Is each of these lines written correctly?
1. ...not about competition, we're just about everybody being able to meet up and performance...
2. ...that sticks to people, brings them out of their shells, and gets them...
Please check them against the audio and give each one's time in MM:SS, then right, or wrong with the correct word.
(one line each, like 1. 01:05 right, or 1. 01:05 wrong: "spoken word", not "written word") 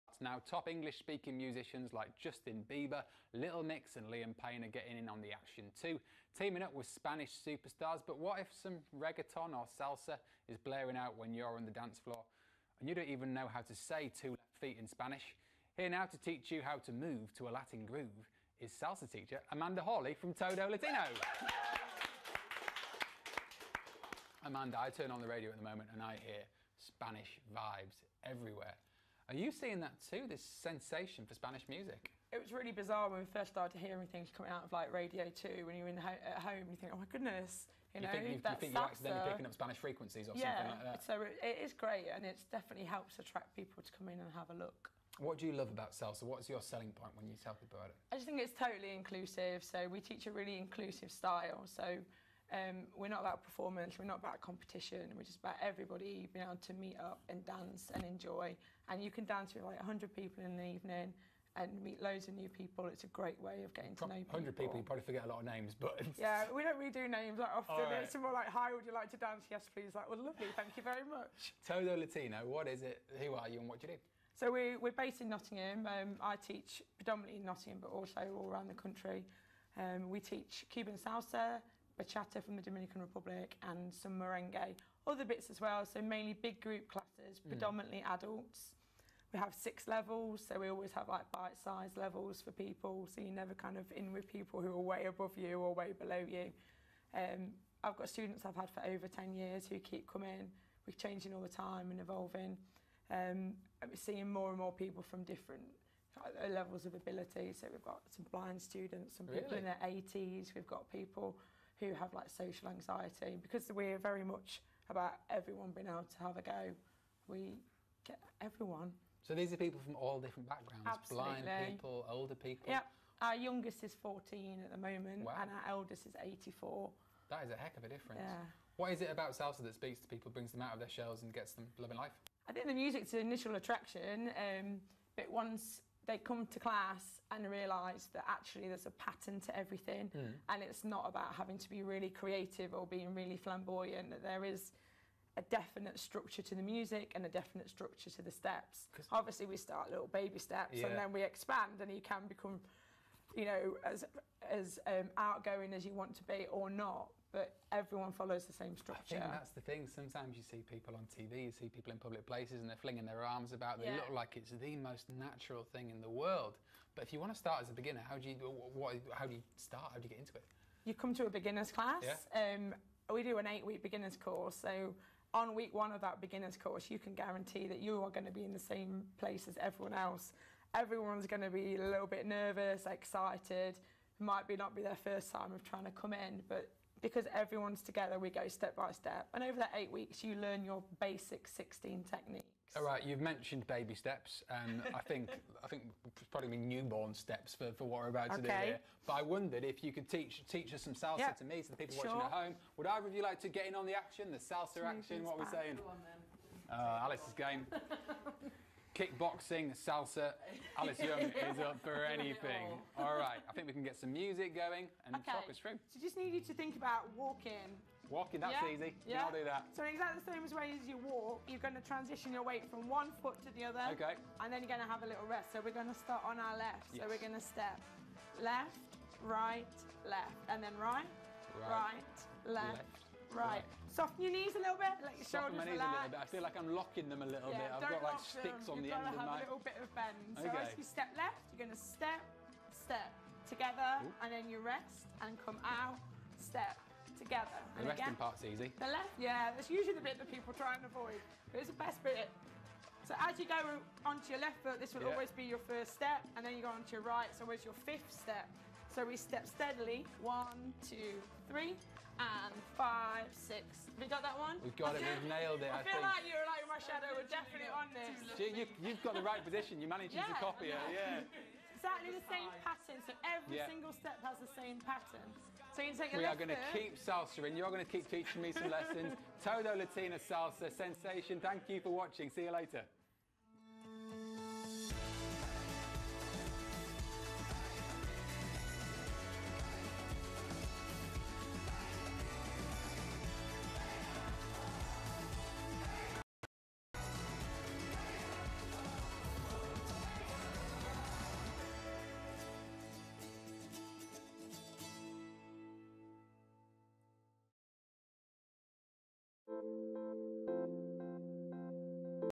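1. 00:54 wrong: "dance", not "performance"
2. 02:09 wrong: "speaks", not "sticks".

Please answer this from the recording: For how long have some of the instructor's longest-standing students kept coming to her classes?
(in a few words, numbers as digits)
Over 10 years.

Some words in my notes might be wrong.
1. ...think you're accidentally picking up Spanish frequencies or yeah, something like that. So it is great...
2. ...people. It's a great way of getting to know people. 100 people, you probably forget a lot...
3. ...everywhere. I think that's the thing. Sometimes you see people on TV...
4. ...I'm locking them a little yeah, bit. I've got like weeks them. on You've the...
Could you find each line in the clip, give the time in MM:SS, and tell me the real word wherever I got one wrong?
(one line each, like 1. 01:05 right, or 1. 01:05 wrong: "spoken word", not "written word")
1. 00:38 right
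2. 01:02 right
3. 02:38 wrong: "structure", not "everywhere"
4. 03:56 wrong: "sticks", not "weeks".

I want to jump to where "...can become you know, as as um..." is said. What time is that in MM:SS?
02:32.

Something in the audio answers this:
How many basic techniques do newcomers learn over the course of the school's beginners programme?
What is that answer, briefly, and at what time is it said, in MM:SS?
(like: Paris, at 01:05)
16, at 03:11.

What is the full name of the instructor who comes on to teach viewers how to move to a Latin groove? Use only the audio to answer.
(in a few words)
Amanda Hawley.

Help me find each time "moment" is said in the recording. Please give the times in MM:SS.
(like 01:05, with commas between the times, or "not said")
00:25, 02:04.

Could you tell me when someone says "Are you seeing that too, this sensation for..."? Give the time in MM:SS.
00:29.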